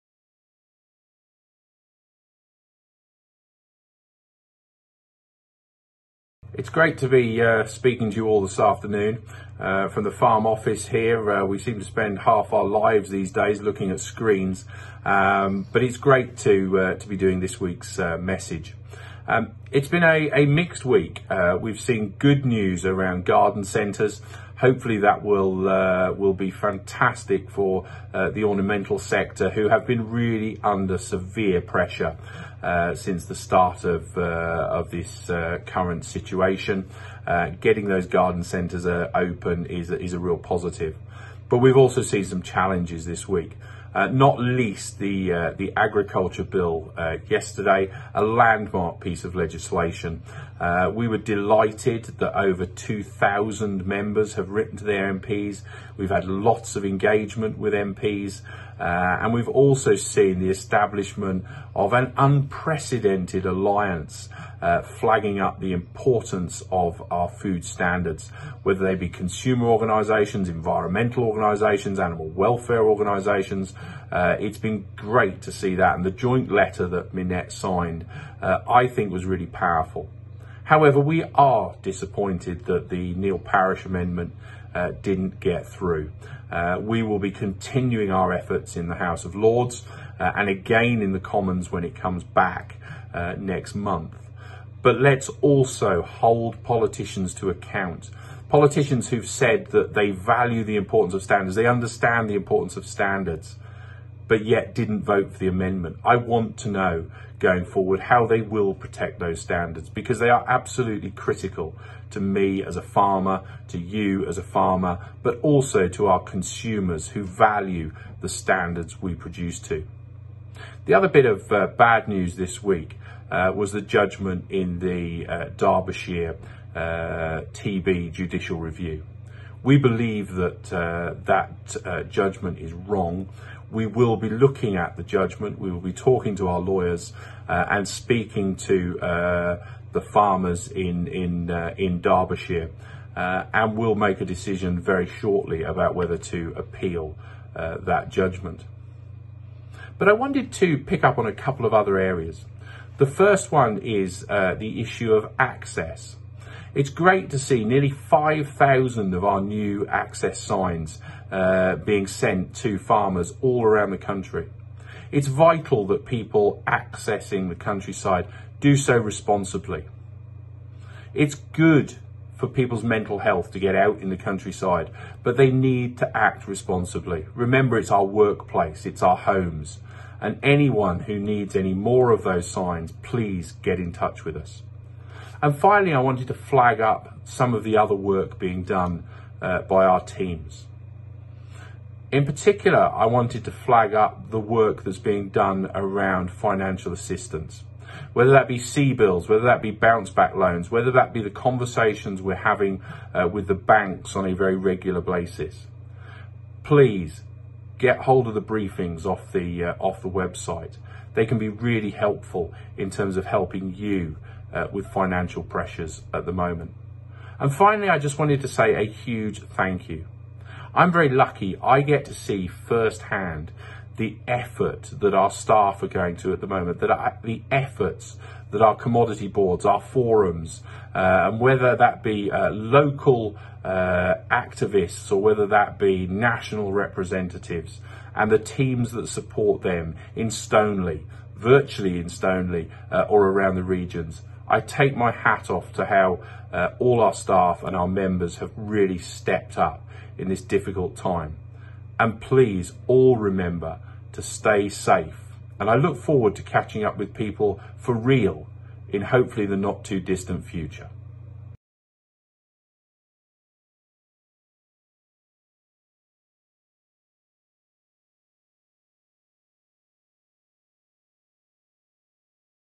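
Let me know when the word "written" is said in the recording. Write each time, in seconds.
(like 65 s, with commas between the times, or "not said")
54 s.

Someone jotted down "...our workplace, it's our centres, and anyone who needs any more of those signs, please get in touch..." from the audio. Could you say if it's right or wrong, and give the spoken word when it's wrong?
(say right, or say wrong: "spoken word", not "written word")
wrong: "homes", not "centres".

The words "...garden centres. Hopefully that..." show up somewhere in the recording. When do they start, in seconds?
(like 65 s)
23 s.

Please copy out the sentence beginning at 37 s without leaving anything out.
Uh, getting those garden centres open is is a real positive.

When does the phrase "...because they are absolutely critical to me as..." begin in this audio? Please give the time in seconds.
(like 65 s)
109 s.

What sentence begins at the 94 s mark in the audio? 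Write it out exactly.
But let's also hold politicians to account.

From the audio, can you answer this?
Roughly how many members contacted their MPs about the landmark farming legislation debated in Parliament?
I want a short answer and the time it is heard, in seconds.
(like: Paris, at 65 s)
over 2,000, at 52 s.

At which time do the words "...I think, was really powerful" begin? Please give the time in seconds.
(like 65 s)
78 s.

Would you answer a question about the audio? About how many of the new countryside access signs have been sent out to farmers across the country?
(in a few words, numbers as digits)
nearly 5,000.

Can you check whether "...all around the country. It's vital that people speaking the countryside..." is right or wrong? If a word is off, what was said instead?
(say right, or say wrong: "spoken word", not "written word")
wrong: "accessing", not "speaking".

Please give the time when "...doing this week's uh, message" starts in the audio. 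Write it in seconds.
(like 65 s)
17 s.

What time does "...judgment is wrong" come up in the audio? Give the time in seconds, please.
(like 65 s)
132 s.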